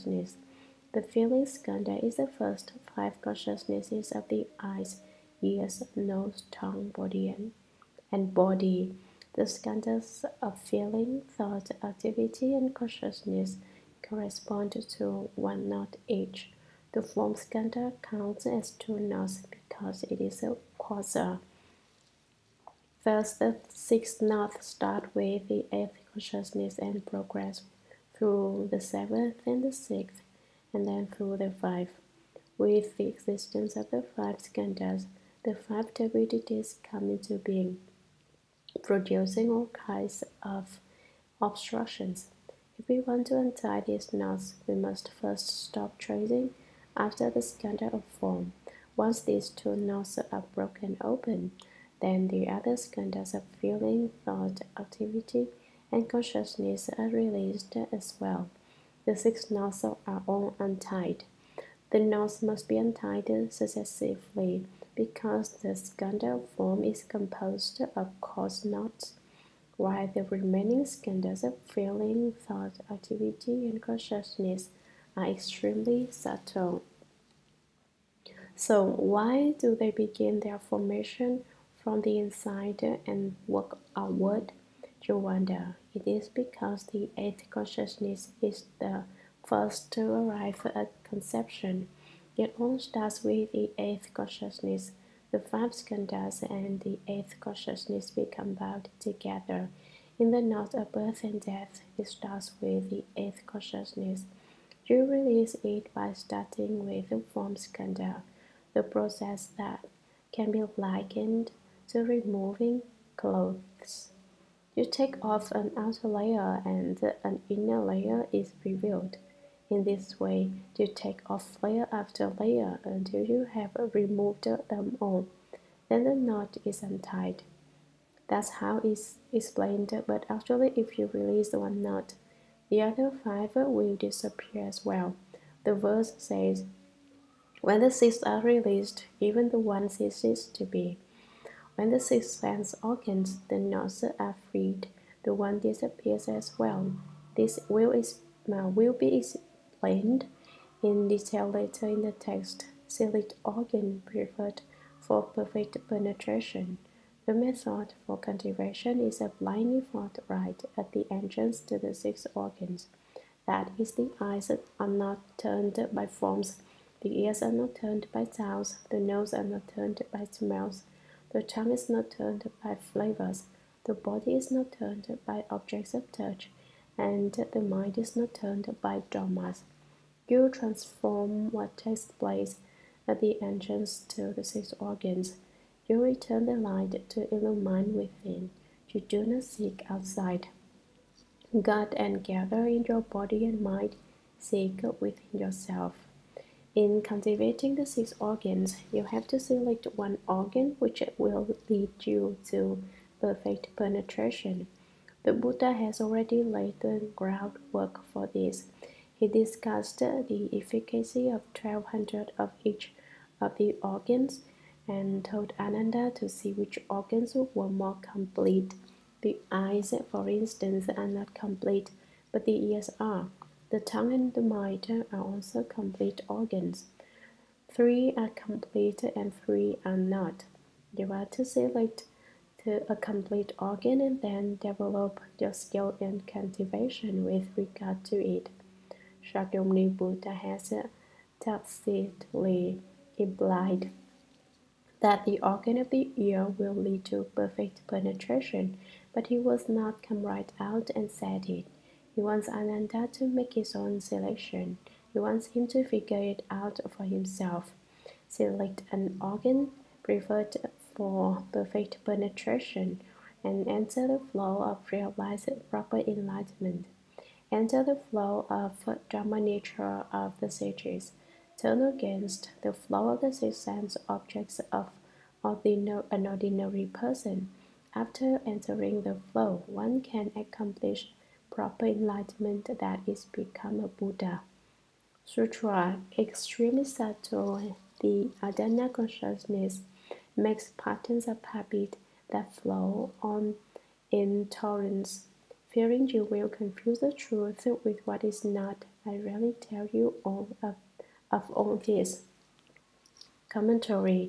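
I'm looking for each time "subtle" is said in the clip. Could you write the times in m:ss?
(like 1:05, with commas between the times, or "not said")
1:16, 4:46.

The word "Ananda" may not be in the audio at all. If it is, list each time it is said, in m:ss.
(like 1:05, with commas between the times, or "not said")
3:35, 4:12.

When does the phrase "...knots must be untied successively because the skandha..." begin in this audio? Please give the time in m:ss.
1:01.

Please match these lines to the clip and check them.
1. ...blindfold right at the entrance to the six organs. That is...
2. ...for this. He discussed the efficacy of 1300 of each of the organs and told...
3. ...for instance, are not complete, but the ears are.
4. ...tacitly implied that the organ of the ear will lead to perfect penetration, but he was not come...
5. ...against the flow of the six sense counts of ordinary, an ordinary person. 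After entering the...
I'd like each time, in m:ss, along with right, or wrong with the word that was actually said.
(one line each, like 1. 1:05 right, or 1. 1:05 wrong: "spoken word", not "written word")
1. 2:39 right
2. 3:28 wrong: "1200", not "1300"
3. 3:40 right
4. 4:01 right
5. 4:31 wrong: "objects", not "counts".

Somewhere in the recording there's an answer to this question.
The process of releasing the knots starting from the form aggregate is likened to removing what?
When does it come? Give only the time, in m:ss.
1:52.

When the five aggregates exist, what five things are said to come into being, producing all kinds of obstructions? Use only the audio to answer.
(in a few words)
5 turbidities.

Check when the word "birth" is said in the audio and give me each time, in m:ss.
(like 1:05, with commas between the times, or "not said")
1:40.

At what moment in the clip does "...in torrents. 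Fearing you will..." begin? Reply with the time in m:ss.
4:54.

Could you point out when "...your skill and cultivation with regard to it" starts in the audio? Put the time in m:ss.
3:55.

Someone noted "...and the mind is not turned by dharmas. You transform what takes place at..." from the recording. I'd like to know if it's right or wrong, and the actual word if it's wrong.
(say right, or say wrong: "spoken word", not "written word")
right.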